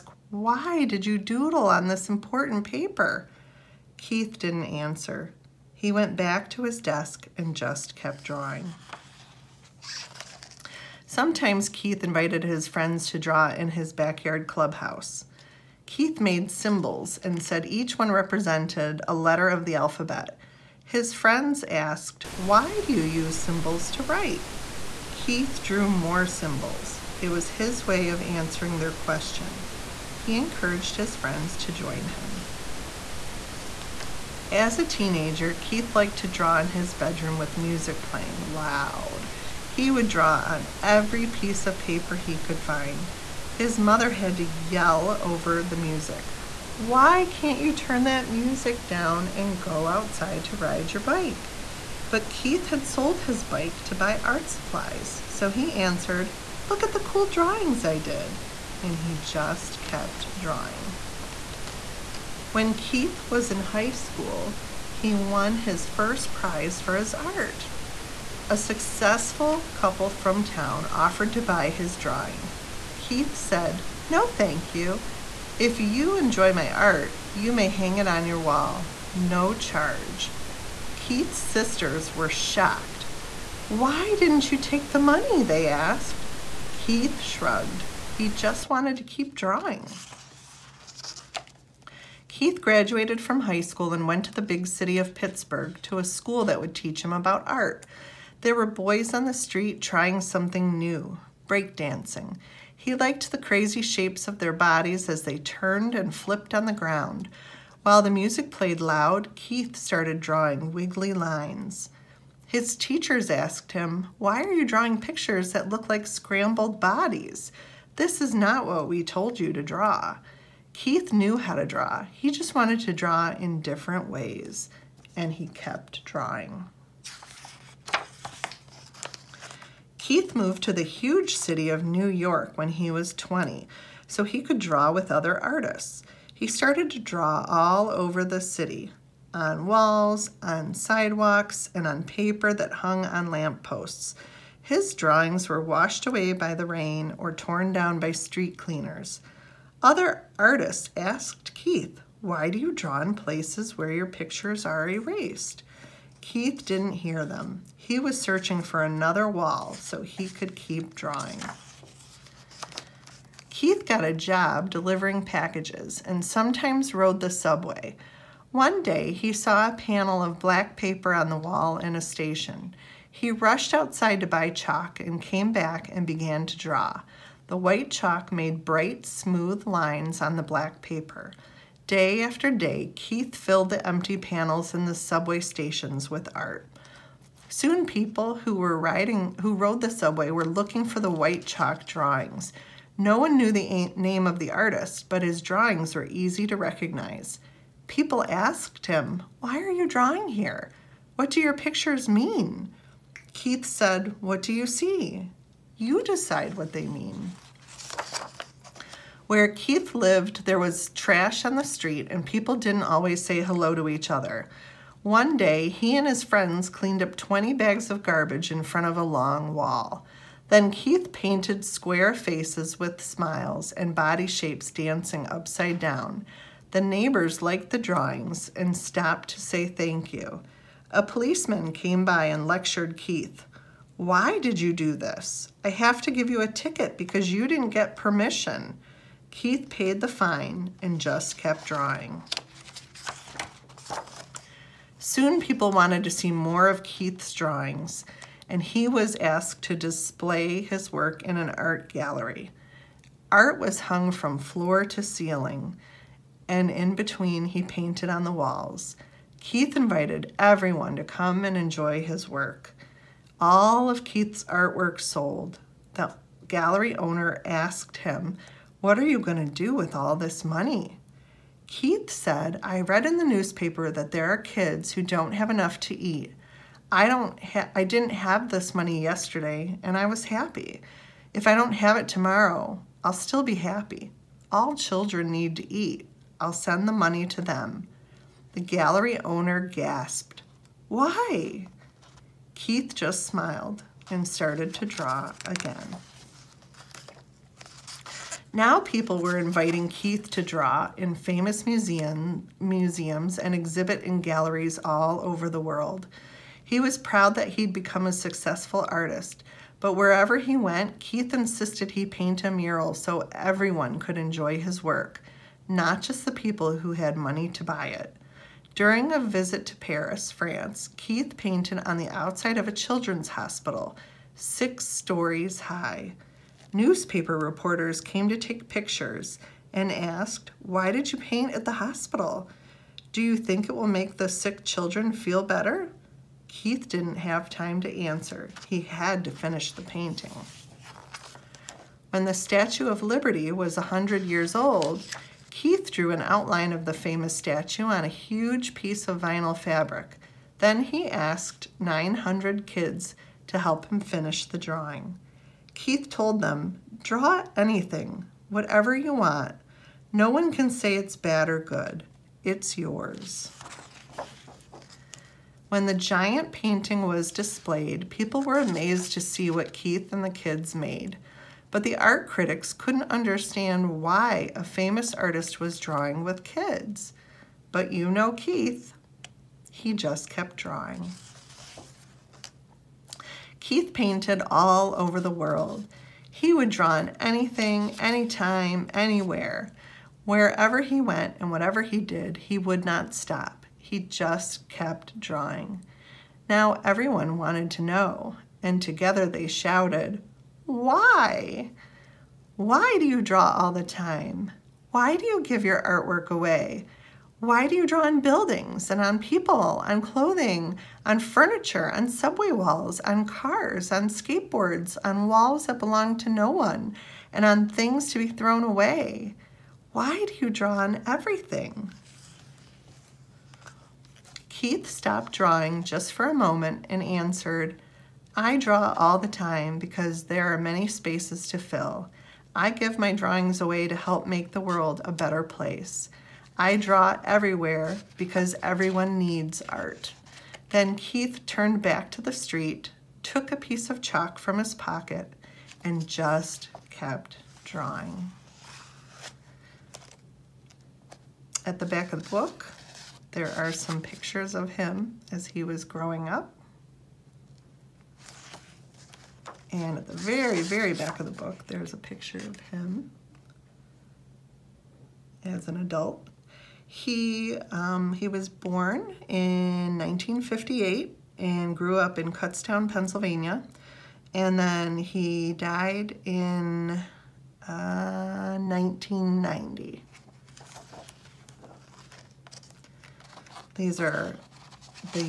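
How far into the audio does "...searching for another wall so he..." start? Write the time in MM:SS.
02:38.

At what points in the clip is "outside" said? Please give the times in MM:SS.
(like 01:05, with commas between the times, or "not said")
00:49, 02:53, 05:22.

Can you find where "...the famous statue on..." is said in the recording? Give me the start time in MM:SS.
05:46.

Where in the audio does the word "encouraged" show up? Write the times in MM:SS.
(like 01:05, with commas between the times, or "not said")
00:30.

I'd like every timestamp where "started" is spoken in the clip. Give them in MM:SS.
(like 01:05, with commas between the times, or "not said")
01:49, 02:16, 04:54.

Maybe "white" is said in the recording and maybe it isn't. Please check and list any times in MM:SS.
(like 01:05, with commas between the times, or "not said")
02:57, 03:11.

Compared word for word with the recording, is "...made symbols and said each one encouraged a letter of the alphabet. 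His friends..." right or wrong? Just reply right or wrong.
wrong.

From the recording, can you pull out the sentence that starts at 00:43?
His mother had to yell over the music.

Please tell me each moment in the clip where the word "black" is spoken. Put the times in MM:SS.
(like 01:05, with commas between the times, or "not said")
02:50, 03:00.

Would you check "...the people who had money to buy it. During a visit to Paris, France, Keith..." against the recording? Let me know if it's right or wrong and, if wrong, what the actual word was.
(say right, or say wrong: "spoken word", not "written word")
right.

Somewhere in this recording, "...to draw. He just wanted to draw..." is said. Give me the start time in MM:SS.
02:01.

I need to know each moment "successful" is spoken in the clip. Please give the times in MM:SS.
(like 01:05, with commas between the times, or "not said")
01:08, 05:08.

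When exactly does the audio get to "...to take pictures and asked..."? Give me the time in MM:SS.
05:28.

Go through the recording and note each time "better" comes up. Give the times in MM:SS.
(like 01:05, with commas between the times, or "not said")
05:35, 07:15.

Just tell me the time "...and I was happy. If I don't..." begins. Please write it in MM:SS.
04:39.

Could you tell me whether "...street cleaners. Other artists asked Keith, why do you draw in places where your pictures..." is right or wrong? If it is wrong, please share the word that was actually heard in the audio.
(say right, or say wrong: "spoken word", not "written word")
right.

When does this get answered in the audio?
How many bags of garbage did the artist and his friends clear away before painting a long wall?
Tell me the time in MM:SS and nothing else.
03:37.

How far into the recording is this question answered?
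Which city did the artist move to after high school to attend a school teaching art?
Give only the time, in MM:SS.
01:35.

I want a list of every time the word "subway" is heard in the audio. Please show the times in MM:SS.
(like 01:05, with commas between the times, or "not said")
02:47, 03:04, 03:09, 06:52.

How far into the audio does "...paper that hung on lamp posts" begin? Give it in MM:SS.
02:22.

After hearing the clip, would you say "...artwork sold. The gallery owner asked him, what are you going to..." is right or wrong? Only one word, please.
right.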